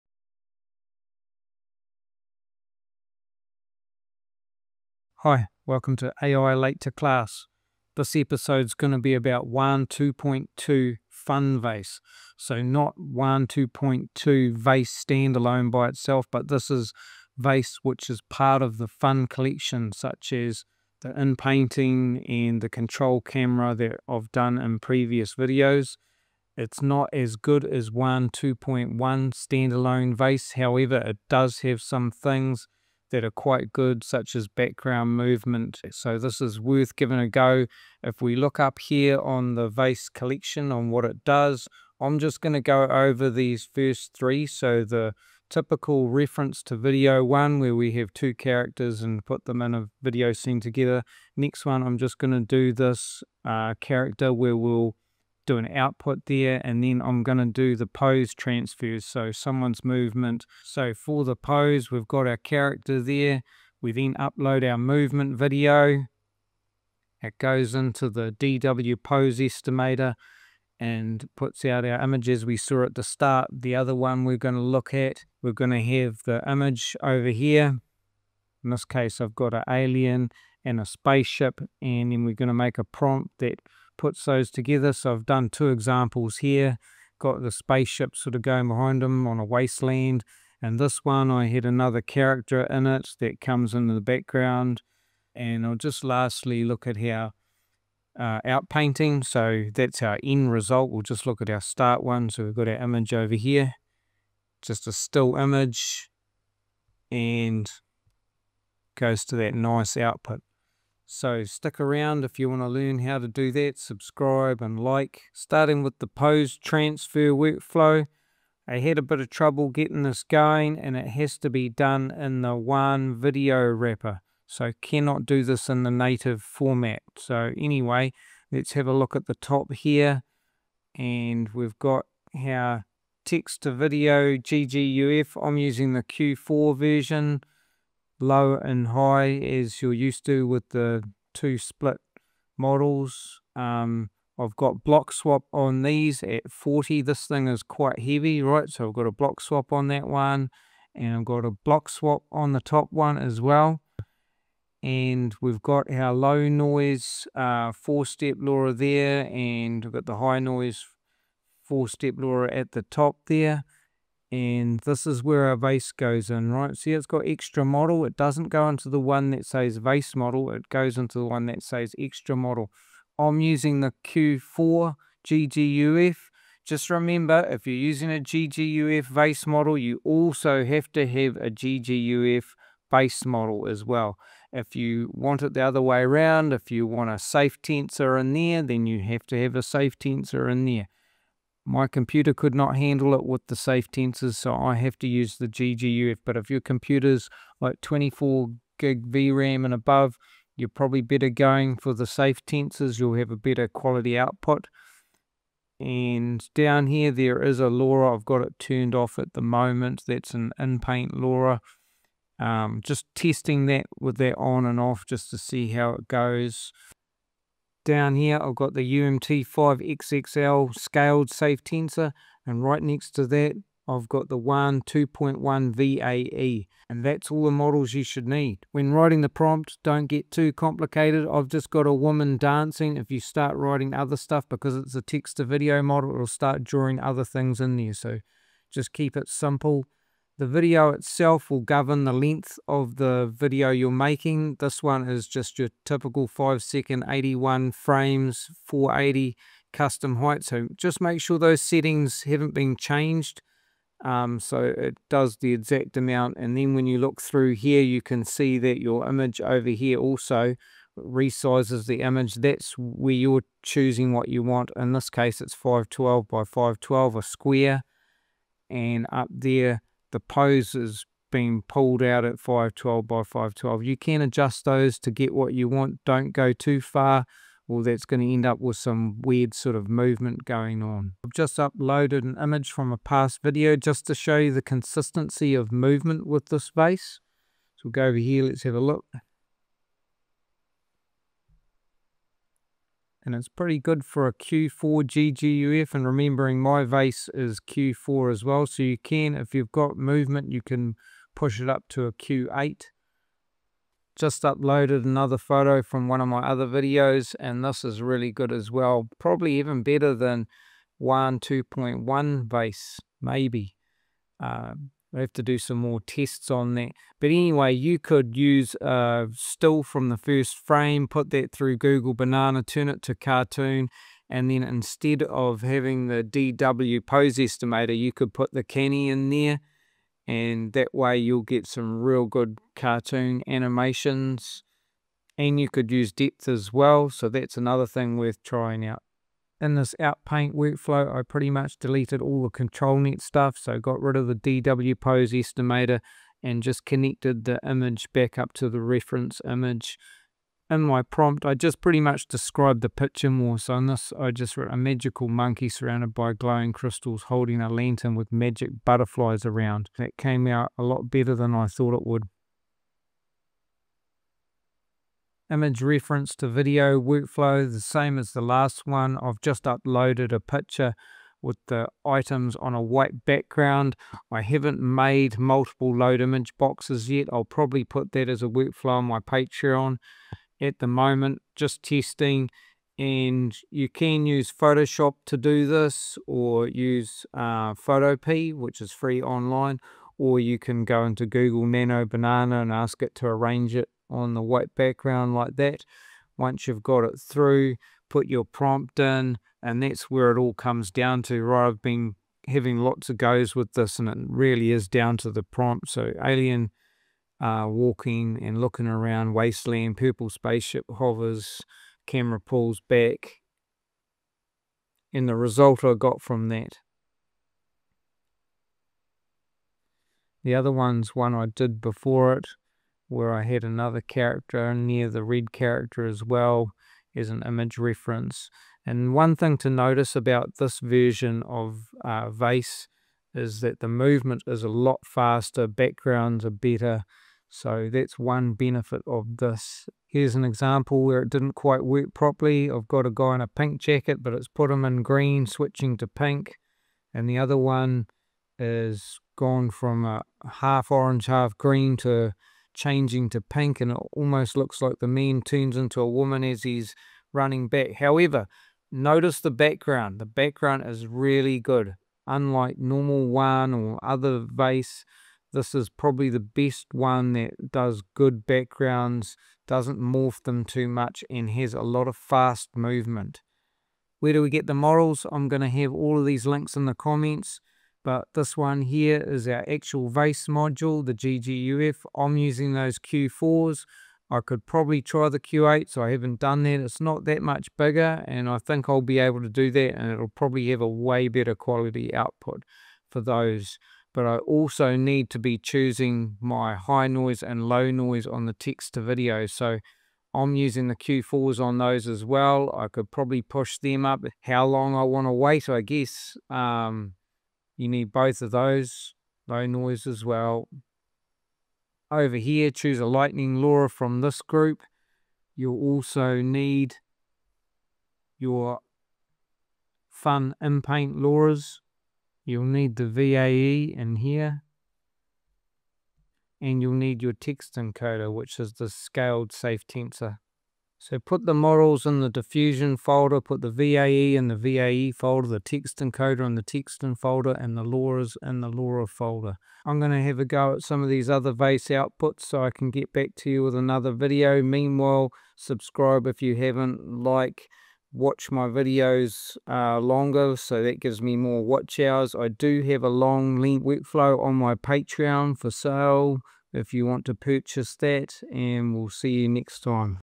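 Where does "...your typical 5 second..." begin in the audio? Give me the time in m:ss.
4:05.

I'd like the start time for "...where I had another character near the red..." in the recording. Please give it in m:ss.
7:03.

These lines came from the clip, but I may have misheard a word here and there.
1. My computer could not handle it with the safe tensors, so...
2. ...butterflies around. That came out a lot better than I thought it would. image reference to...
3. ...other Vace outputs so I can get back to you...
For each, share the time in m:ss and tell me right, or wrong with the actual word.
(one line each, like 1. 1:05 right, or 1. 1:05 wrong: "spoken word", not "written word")
1. 3:11 right
2. 5:58 right
3. 9:01 right.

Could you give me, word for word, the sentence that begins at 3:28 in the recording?
I've got it turned off at the moment.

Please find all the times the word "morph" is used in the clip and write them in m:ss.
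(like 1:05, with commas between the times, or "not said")
7:49.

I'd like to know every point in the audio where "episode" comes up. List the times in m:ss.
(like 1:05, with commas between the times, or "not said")
0:08.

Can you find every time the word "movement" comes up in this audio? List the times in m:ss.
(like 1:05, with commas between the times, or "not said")
0:35, 0:59, 1:04, 4:39, 4:45, 4:59, 7:13, 7:52.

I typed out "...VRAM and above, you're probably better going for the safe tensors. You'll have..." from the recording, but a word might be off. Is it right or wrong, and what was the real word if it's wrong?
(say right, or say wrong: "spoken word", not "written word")
right.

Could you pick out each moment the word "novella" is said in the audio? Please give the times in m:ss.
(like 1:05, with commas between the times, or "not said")
not said.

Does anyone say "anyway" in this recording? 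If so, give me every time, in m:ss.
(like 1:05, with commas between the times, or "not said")
2:07, 5:17.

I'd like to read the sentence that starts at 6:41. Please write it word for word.
I've been having lots of goes with this, and it really is down to the prompt.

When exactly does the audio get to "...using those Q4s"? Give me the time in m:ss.
8:02.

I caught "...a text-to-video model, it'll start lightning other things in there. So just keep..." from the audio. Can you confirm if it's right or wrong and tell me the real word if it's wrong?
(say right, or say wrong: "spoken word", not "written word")
wrong: "drawing", not "lightning".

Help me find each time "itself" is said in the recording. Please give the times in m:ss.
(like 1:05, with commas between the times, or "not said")
0:15, 4:00.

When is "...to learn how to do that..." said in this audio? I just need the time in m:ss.
1:52.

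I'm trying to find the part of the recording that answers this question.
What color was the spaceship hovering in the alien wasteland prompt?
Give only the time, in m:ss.
6:49.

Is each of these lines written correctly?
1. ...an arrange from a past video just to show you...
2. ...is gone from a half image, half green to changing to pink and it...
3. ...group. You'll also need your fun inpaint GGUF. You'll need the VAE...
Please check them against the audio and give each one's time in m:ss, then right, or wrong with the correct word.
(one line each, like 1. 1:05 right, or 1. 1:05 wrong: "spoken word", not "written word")
1. 4:42 wrong: "image", not "arrange"
2. 7:28 wrong: "orange", not "image"
3. 8:34 wrong: "LoRas", not "GGUF".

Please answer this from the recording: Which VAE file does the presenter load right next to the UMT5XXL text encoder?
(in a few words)
WAN 2.1 VAE.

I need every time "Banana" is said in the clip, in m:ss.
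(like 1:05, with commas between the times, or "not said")
5:22, 6:32.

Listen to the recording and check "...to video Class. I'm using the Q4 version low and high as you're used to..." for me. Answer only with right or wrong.
wrong.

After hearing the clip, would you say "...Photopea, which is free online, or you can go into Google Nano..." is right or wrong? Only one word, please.
right.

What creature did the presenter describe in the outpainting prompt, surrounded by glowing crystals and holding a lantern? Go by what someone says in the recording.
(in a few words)
magical monkey.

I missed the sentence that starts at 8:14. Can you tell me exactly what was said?
But I also need to be choosing my high noise and low noise on the text to video.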